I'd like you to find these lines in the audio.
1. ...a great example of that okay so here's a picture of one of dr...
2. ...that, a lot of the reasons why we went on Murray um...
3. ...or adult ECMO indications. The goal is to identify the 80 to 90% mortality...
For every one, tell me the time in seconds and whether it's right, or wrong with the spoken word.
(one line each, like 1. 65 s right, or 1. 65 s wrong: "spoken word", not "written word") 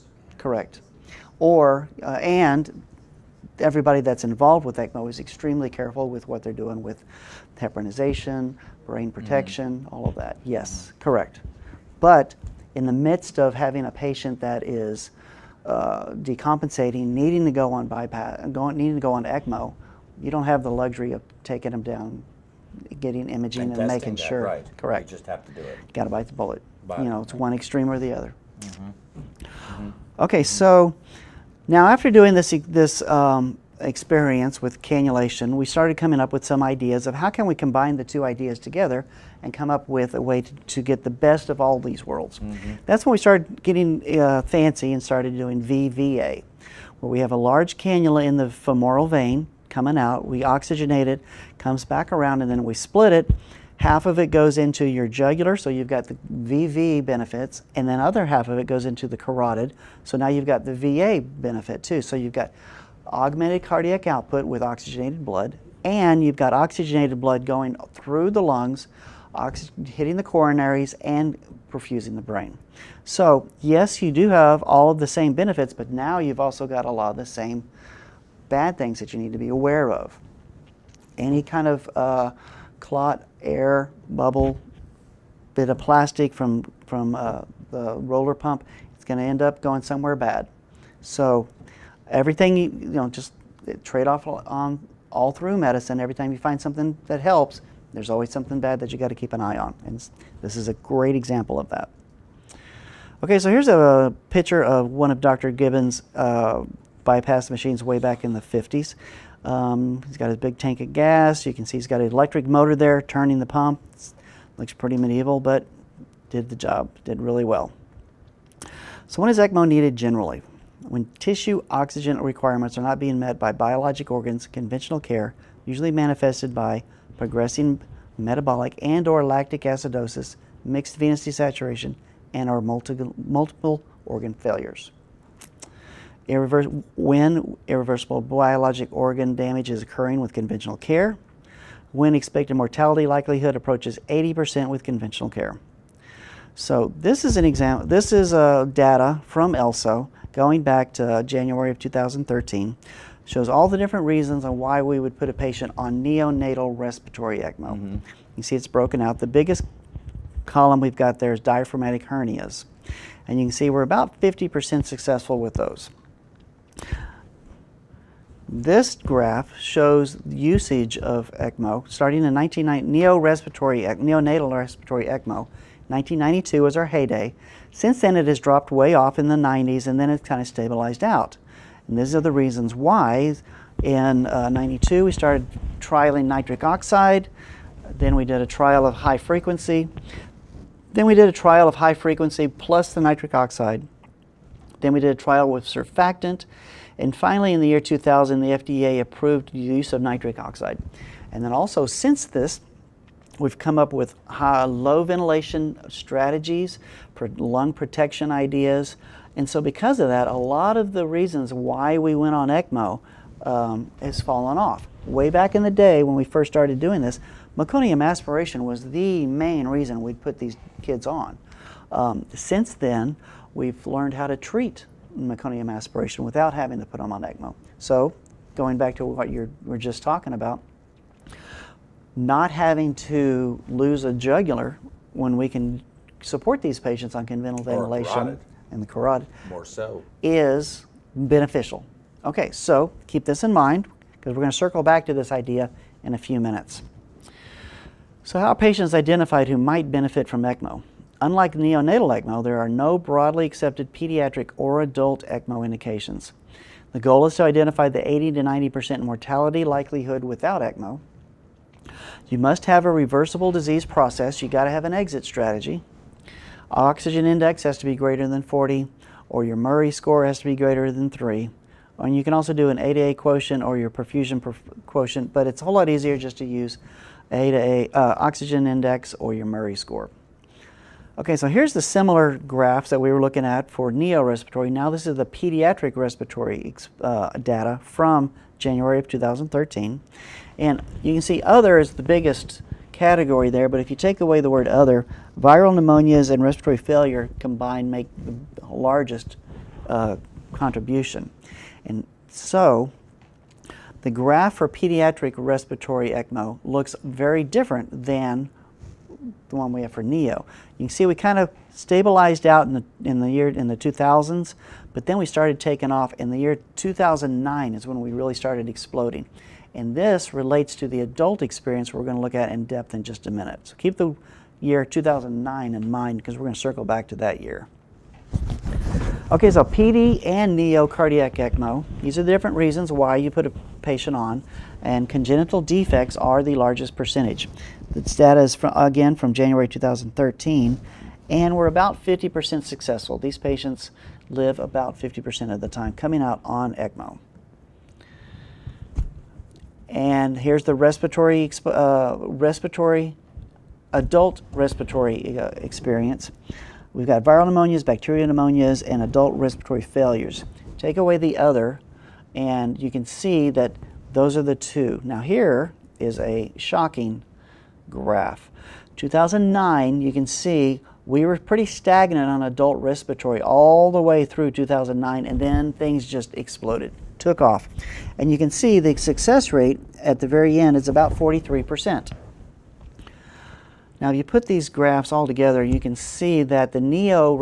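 1. 100 s right
2. 210 s wrong: "ECMO", not "Murray"
3. 254 s right.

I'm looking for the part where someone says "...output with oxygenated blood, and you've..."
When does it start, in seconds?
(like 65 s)
64 s.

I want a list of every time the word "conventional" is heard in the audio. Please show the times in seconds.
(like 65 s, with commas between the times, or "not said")
124 s, 140 s, 144 s, 237 s.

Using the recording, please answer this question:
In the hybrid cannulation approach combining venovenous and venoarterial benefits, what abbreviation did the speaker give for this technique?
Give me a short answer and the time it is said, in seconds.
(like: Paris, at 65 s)
VVA, at 45 s.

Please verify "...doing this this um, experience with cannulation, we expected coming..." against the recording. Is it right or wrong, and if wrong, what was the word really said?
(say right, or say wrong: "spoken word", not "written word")
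wrong: "started", not "expected".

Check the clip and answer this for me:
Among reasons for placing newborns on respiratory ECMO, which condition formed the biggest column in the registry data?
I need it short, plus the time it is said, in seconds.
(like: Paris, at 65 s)
Diaphragmatic hernias, at 161 s.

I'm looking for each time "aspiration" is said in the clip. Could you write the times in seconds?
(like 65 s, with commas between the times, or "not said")
218 s, 225 s.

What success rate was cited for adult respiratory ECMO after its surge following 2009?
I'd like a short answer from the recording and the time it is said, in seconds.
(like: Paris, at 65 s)
43%, at 381 s.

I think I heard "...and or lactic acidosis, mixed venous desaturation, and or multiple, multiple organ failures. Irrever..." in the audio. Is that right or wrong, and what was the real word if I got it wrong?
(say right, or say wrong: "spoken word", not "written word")
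right.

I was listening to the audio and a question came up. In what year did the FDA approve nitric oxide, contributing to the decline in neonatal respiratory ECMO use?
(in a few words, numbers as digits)
2000.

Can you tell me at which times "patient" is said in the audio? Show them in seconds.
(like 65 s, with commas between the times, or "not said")
13 s, 155 s, 236 s, 248 s, 333 s, 343 s.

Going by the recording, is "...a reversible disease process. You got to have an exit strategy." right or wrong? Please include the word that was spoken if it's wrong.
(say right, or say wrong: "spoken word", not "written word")
right.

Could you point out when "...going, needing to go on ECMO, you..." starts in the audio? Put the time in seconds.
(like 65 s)
18 s.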